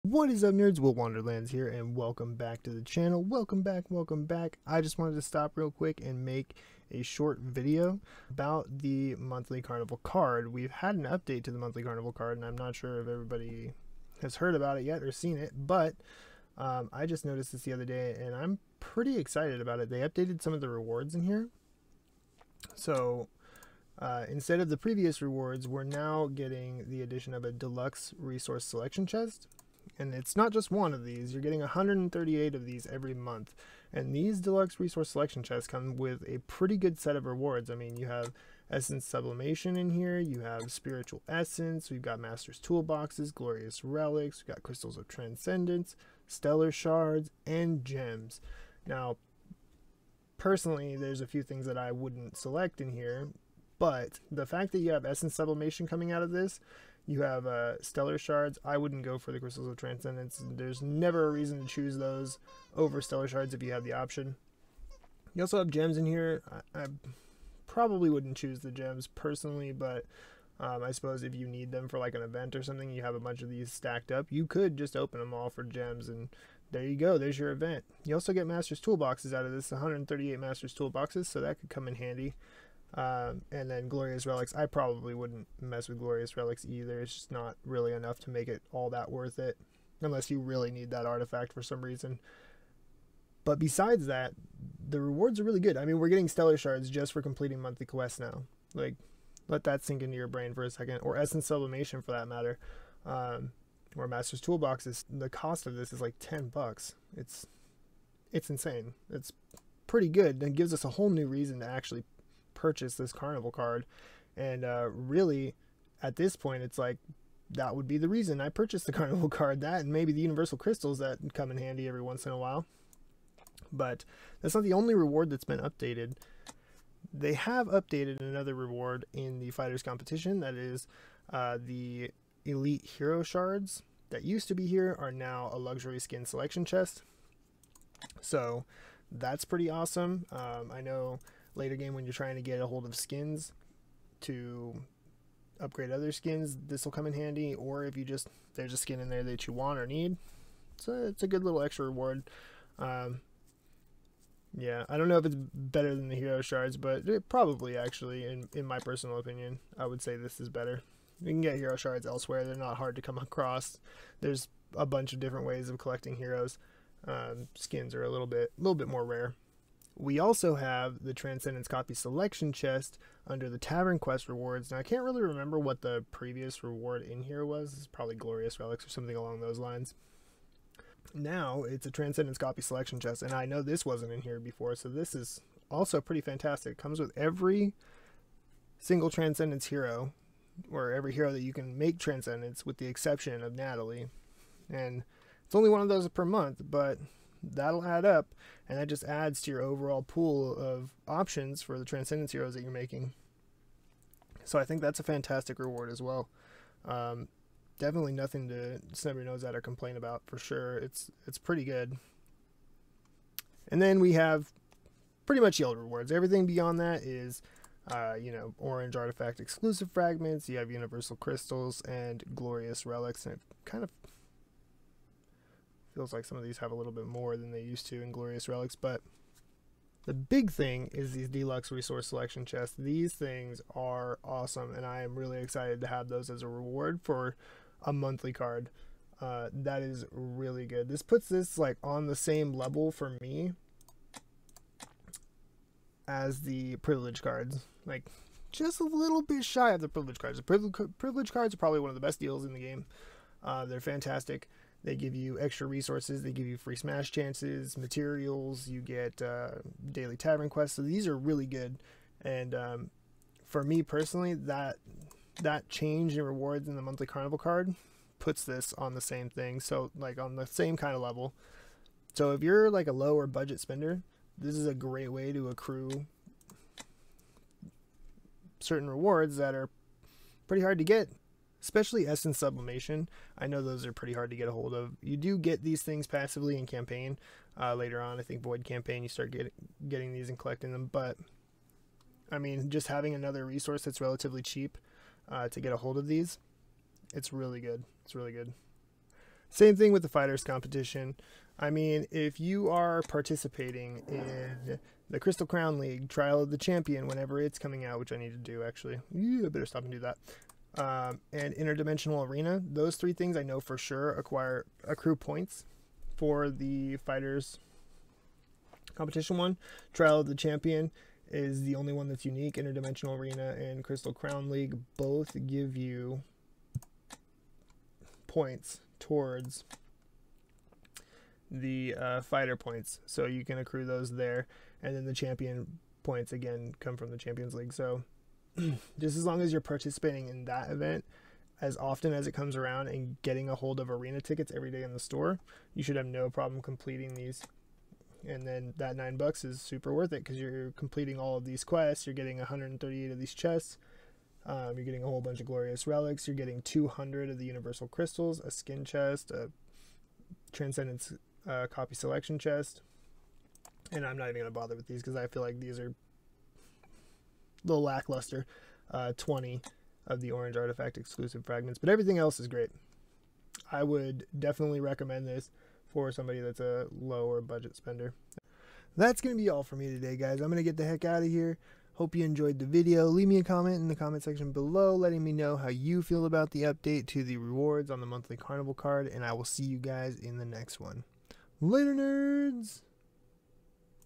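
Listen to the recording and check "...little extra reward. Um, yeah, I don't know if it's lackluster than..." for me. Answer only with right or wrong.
wrong.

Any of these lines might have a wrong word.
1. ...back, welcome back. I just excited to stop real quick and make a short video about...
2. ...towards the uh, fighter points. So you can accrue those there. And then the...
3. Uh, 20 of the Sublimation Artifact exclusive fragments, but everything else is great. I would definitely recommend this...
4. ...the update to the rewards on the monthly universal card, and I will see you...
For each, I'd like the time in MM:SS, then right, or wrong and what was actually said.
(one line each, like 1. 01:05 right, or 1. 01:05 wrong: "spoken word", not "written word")
1. 00:03 wrong: "wanted", not "excited"
2. 05:28 right
3. 06:08 wrong: "Orange", not "Sublimation"
4. 06:26 wrong: "carnival", not "universal".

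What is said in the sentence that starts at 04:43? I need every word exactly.
I know those are pretty hard to get a hold of.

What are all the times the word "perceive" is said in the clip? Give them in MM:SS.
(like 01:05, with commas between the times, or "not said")
not said.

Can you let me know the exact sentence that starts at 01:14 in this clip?
You could just open them all for gems and there you go.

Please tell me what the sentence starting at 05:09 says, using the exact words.
Yeah, I better stop and do that um, and interdimensional arena.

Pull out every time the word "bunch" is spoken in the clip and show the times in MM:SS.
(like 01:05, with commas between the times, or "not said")
01:13, 02:44, 05:55.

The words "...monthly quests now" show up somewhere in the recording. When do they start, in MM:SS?
01:37.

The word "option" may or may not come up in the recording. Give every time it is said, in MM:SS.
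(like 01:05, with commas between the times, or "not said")
01:03, 03:21.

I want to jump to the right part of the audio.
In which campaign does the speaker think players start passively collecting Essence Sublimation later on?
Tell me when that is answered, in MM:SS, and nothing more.
04:48.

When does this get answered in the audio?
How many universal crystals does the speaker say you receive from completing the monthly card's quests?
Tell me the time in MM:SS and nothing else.
05:56.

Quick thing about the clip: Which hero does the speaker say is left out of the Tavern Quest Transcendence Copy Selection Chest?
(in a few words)
Natalie.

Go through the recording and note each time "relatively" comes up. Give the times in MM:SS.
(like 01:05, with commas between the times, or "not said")
04:54.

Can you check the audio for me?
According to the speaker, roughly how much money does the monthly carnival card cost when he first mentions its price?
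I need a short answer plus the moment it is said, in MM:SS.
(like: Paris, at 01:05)
10 bucks, at 01:46.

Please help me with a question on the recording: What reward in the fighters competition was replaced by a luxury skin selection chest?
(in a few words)
elite hero shards.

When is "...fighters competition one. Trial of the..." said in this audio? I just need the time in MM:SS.
05:16.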